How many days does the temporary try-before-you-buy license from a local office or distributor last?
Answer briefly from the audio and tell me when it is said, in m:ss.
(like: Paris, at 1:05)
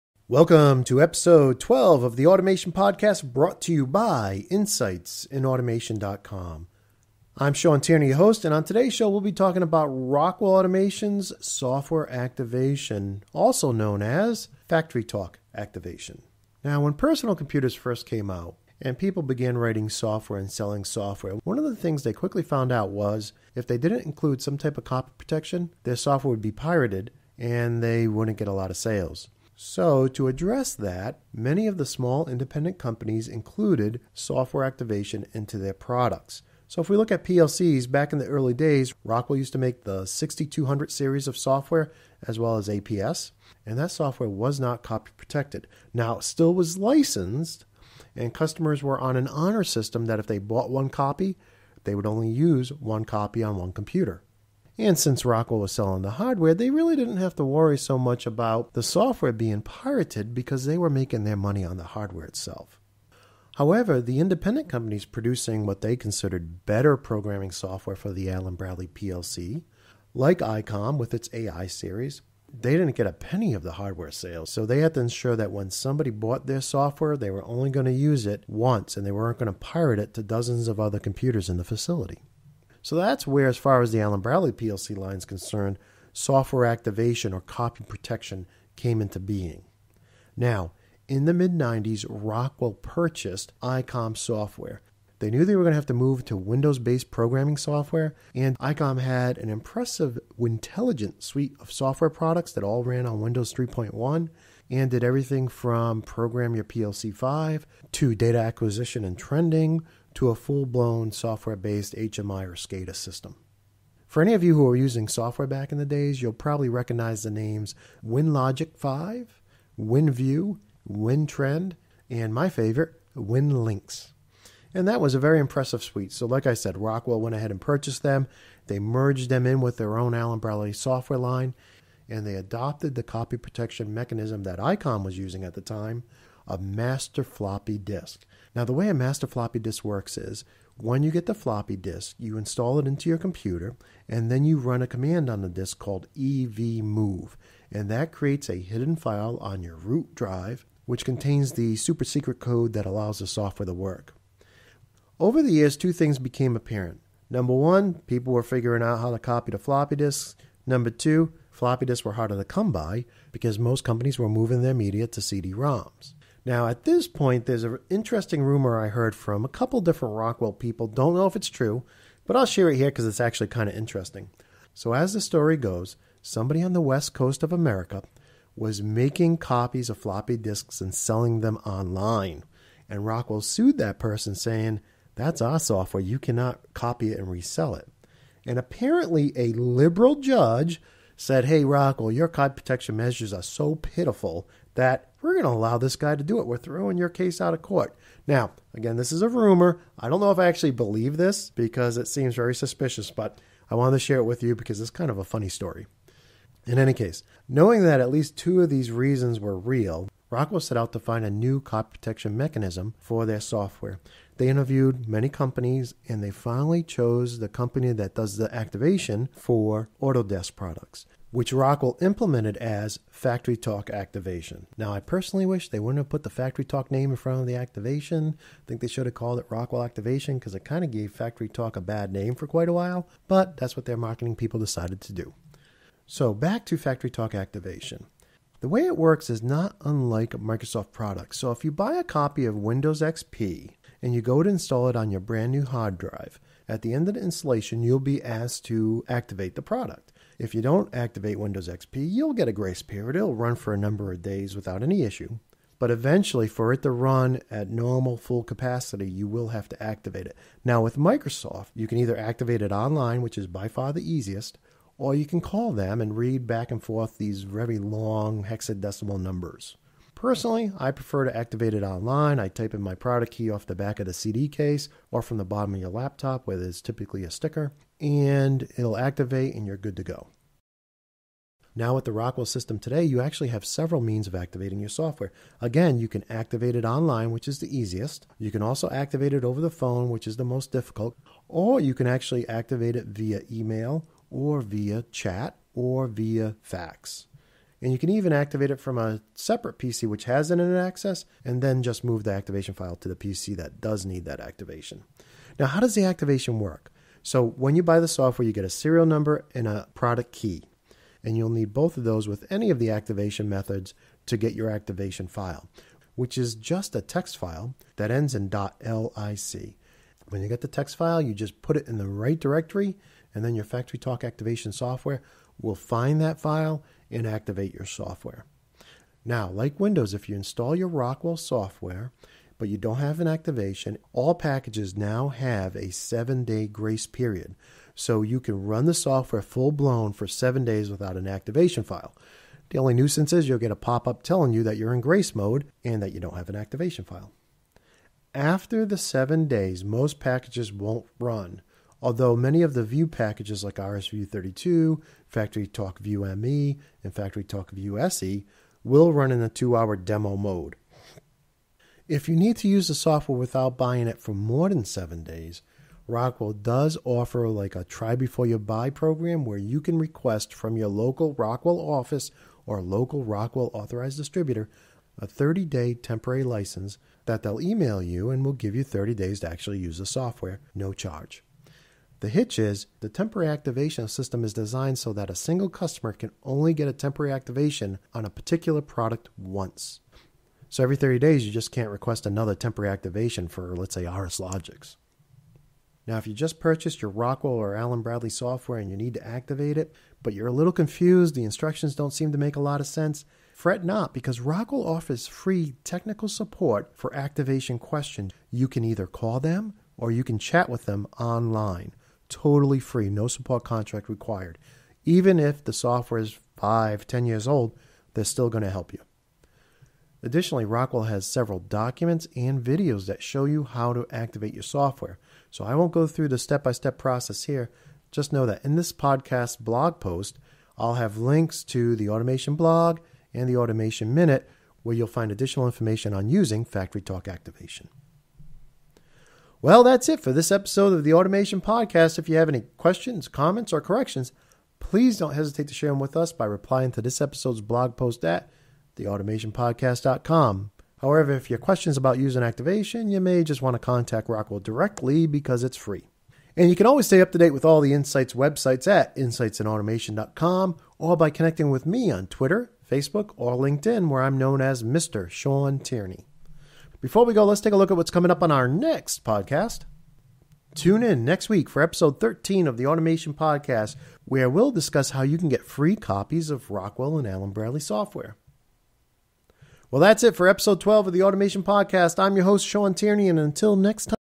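30 days, at 6:15.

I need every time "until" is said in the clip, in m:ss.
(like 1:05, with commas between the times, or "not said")
8:03.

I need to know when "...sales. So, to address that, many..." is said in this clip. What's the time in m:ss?
0:28.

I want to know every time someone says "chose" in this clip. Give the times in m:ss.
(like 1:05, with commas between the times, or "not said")
3:36.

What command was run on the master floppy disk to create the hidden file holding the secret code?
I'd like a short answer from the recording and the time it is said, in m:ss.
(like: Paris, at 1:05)
evmove, at 2:26.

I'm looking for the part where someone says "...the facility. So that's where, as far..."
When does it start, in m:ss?
1:21.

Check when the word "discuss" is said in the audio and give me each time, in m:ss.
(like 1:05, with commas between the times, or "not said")
7:54.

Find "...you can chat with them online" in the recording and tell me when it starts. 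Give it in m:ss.
6:50.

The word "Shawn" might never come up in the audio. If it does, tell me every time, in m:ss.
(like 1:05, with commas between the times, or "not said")
0:07, 7:45, 8:02.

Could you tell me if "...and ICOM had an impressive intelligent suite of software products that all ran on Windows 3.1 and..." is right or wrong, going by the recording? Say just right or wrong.
right.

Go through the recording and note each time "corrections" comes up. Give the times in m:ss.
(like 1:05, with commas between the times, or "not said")
7:23.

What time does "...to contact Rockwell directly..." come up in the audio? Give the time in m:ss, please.
7:33.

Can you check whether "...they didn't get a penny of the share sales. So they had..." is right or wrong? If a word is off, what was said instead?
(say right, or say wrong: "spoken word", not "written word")
wrong: "hardware", not "share".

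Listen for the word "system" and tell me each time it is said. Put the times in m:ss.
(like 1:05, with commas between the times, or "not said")
0:49, 1:52, 4:42, 6:24.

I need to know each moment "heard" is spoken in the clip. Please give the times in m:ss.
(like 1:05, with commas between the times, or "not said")
2:48.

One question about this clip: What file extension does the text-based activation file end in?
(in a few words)
.lic.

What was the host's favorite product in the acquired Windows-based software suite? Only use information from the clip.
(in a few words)
WinLinks.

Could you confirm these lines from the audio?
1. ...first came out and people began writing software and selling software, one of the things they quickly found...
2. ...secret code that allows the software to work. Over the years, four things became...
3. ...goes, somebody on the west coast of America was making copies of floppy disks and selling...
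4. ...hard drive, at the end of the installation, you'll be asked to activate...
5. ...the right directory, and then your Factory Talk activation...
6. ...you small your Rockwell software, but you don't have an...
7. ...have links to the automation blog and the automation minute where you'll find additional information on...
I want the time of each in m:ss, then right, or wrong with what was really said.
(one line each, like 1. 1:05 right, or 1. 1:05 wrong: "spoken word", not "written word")
1. 0:17 right
2. 2:32 wrong: "two", not "four"
3. 2:55 right
4. 4:05 right
5. 5:21 right
6. 5:30 wrong: "install", not "small"
7. 7:10 right.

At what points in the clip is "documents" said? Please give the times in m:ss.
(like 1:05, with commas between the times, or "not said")
7:01.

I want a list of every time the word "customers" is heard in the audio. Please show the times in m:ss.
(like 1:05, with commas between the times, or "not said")
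0:48, 6:25.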